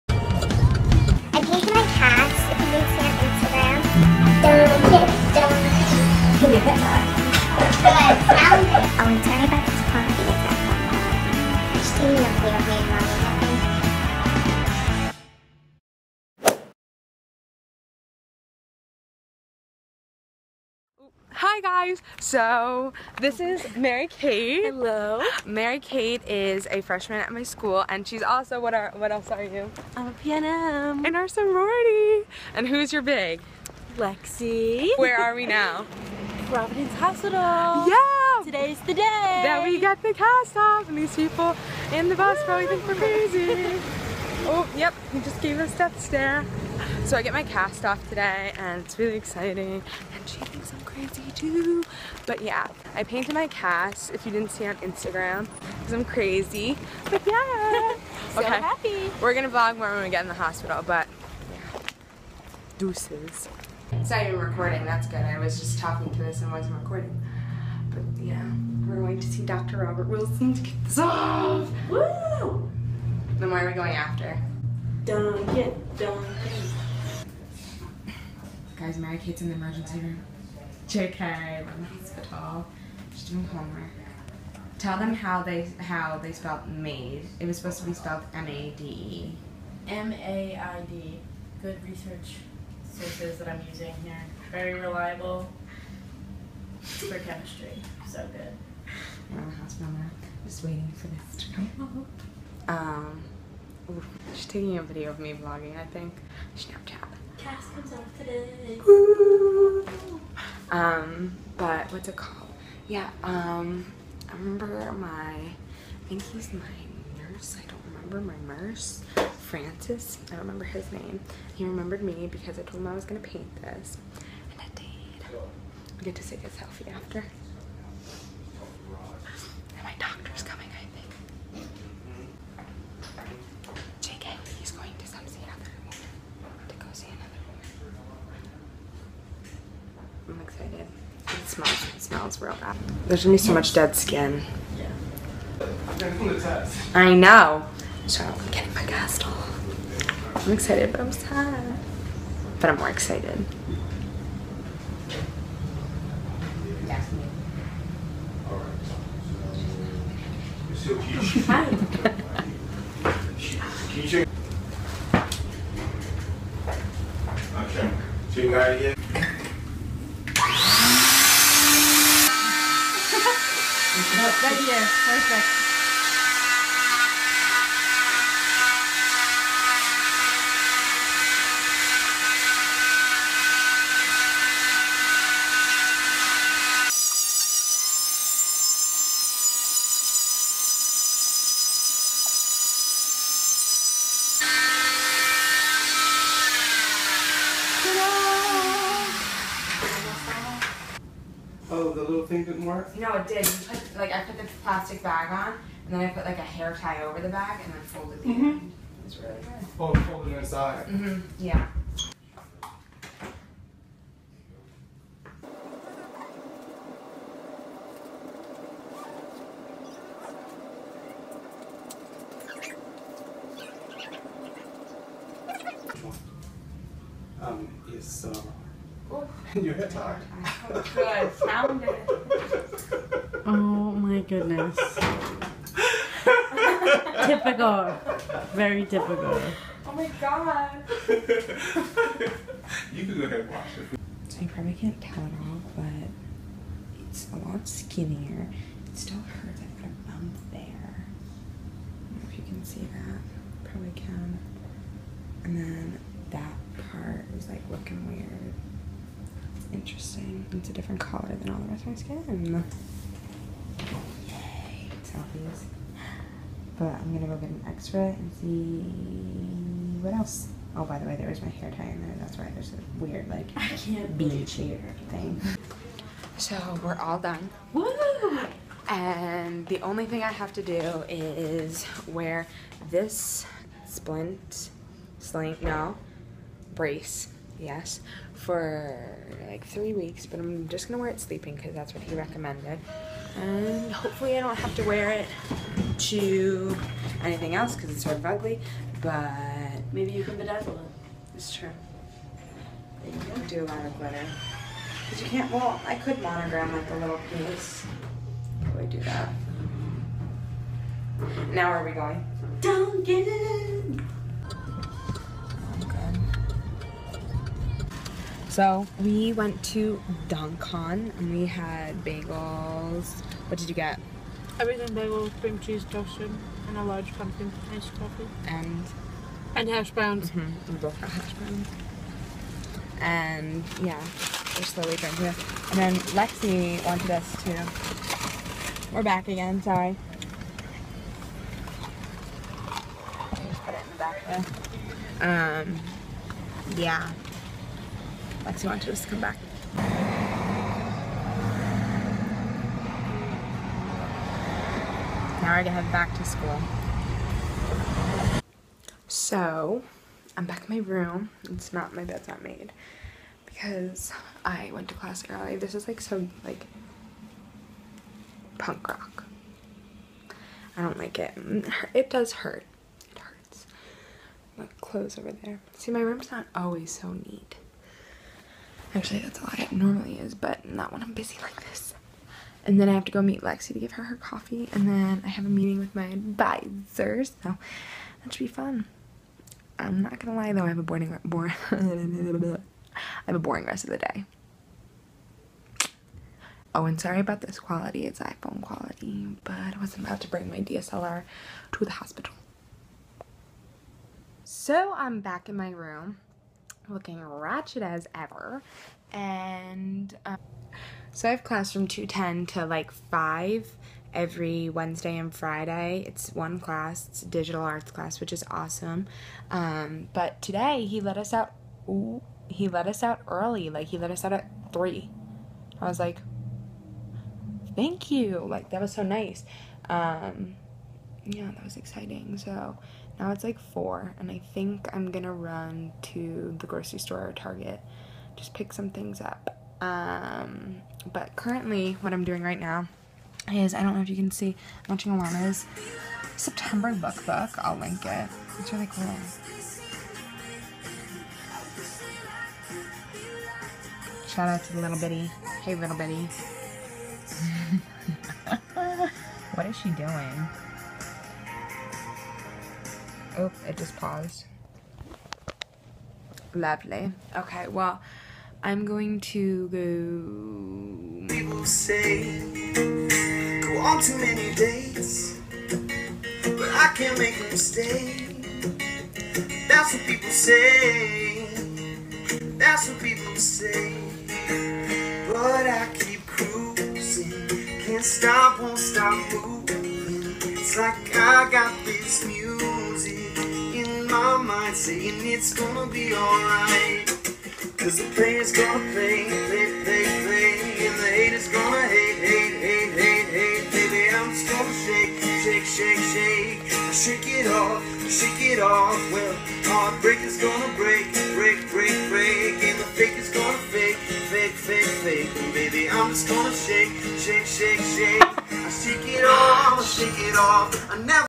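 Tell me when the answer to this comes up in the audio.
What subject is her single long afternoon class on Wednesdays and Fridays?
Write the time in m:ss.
6:57.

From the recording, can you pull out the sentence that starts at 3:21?
Oh, the little thing didn't work?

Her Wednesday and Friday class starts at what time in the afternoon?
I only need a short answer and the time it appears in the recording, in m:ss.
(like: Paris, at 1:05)
2:10, at 6:51.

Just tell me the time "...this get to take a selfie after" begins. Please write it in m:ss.
2:03.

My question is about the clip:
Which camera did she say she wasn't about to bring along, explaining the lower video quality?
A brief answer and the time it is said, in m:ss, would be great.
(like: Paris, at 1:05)
DSLR, at 6:40.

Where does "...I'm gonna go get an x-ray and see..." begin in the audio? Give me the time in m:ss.
4:26.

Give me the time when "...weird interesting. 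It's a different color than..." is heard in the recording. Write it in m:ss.
4:18.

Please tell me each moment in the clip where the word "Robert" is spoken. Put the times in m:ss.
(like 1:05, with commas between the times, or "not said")
1:09.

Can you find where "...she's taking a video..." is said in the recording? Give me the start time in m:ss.
1:44.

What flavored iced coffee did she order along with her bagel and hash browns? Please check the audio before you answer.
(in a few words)
Pumpkin.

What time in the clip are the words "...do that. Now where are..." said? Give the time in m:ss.
5:08.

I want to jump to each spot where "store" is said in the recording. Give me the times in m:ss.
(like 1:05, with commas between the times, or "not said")
7:16.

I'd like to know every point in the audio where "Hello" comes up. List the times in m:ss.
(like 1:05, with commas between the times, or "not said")
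0:24.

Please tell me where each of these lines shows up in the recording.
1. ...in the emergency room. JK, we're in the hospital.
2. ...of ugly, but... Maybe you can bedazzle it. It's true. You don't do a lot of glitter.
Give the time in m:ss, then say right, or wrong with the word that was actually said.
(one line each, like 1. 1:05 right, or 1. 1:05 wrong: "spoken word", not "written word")
1. 1:19 right
2. 4:58 right.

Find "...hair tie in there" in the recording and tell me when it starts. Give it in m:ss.
4:31.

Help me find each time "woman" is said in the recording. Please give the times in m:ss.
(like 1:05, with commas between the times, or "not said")
2:15, 2:20.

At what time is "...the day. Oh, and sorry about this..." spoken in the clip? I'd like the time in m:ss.
6:33.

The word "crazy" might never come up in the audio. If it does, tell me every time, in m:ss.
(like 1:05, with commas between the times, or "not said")
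0:42, 0:50, 0:56.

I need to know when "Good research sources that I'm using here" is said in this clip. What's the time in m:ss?
1:31.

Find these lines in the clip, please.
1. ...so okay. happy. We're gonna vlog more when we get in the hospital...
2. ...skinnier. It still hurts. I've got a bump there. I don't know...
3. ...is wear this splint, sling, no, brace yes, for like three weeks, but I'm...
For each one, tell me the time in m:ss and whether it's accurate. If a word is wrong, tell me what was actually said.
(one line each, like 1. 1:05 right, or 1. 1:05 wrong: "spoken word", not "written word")
1. 0:58 right
2. 4:07 right
3. 4:41 right.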